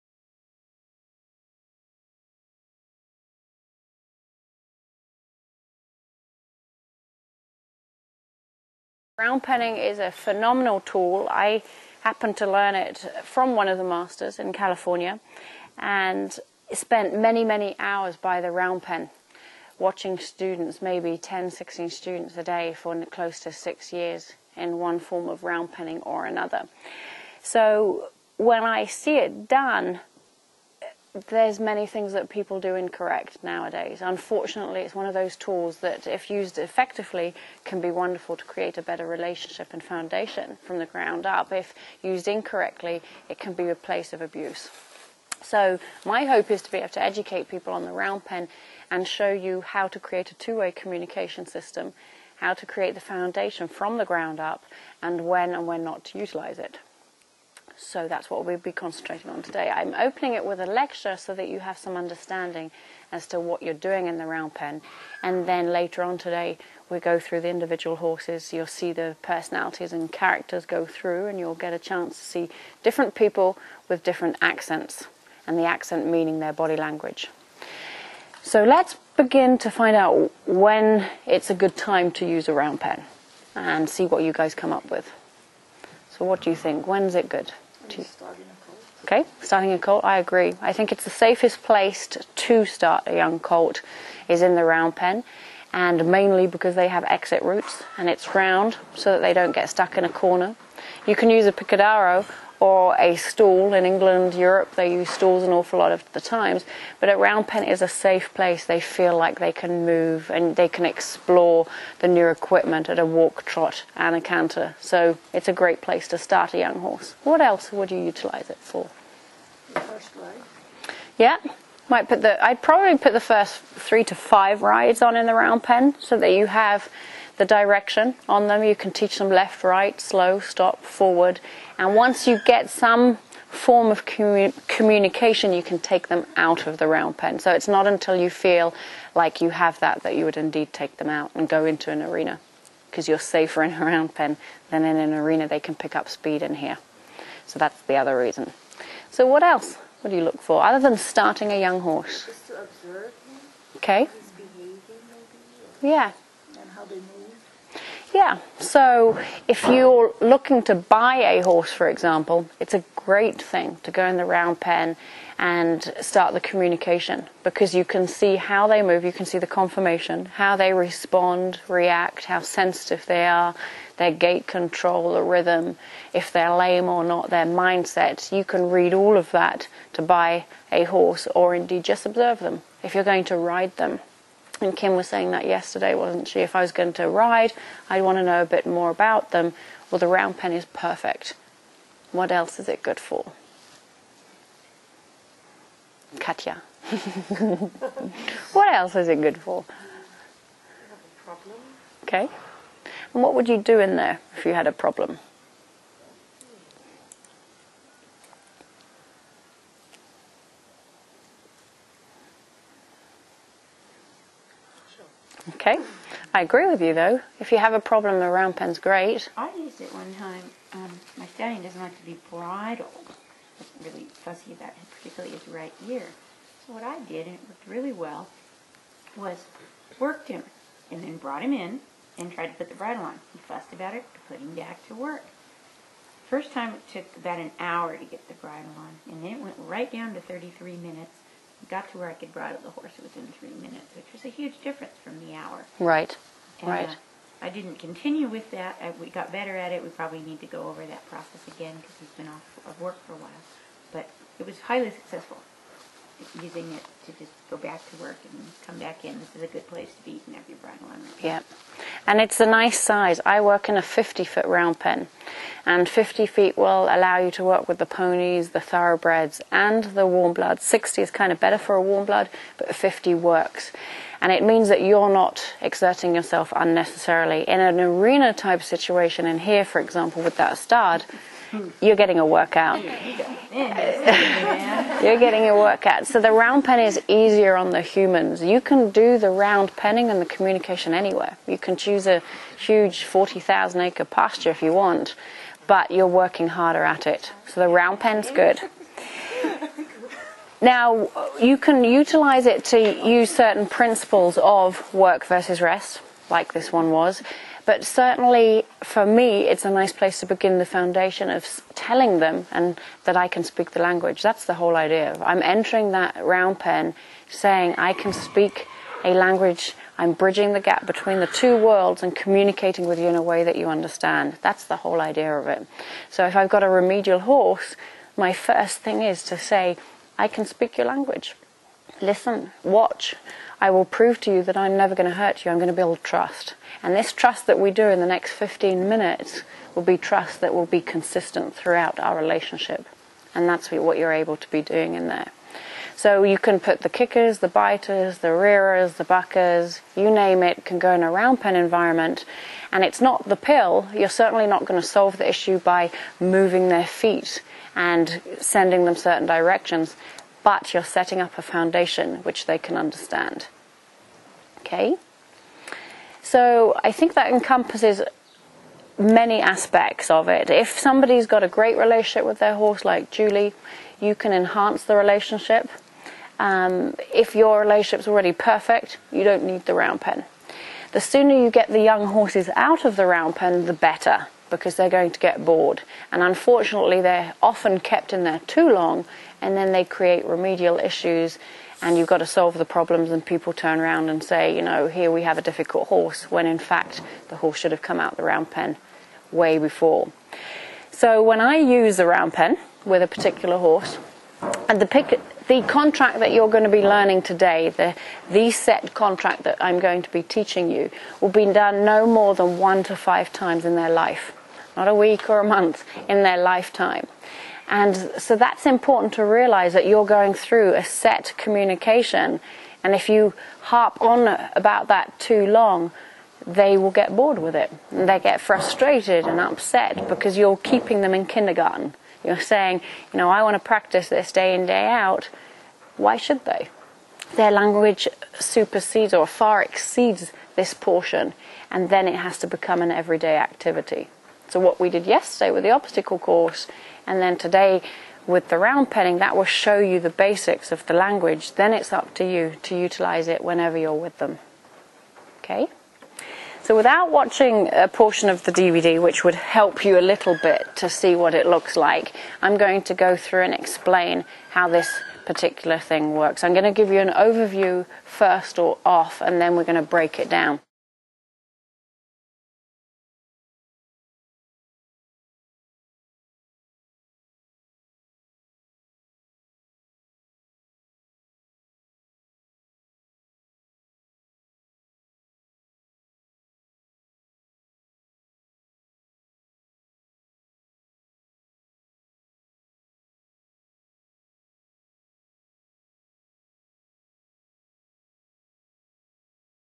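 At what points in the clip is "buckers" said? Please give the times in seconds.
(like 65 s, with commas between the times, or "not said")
349 s.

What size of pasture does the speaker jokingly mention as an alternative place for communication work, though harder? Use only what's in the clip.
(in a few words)
40,000 acres.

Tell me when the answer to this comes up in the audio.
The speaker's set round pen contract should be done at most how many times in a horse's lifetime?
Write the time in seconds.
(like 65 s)
412 s.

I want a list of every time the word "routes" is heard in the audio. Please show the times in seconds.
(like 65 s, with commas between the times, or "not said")
97 s.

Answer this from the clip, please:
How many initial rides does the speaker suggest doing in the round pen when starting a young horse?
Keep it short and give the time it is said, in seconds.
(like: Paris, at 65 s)
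3 to 5, at 123 s.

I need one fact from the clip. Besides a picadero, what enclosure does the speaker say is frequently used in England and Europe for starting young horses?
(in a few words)
stalls.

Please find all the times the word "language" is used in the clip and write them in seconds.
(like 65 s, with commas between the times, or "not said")
76 s, 313 s, 319 s, 330 s, 437 s, 450 s.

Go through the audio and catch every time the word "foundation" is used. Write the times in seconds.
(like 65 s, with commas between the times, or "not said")
39 s, 53 s, 310 s, 361 s.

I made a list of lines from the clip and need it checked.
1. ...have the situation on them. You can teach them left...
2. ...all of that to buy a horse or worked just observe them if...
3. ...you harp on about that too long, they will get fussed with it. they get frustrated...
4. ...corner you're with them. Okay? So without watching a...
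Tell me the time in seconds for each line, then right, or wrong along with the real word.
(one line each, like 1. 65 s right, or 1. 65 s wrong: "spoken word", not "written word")
1. 126 s wrong: "direction", not "situation"
2. 178 s wrong: "indeed", not "worked"
3. 423 s wrong: "bored", not "fussed"
4. 453 s wrong: "whenever", not "corner".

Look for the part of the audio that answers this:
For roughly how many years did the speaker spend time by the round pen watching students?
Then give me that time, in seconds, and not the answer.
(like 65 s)
23 s.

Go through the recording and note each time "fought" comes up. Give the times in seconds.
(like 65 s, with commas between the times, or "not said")
not said.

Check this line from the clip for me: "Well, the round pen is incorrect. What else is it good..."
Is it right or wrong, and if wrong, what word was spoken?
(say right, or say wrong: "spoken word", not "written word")
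wrong: "perfect", not "incorrect".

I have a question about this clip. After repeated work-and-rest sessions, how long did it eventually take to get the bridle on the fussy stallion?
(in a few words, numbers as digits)
3 minutes.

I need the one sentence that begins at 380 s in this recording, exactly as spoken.
The sooner you get the young horses out of the round pen, the better, because they're going to get bored.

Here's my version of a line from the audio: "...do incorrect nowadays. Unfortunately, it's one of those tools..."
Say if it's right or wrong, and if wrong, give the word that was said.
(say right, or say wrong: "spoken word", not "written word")
right.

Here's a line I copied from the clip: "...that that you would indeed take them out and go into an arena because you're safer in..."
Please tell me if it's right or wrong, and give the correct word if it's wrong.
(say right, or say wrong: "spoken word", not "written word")
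right.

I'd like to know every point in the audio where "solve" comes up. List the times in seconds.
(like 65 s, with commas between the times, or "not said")
354 s, 392 s.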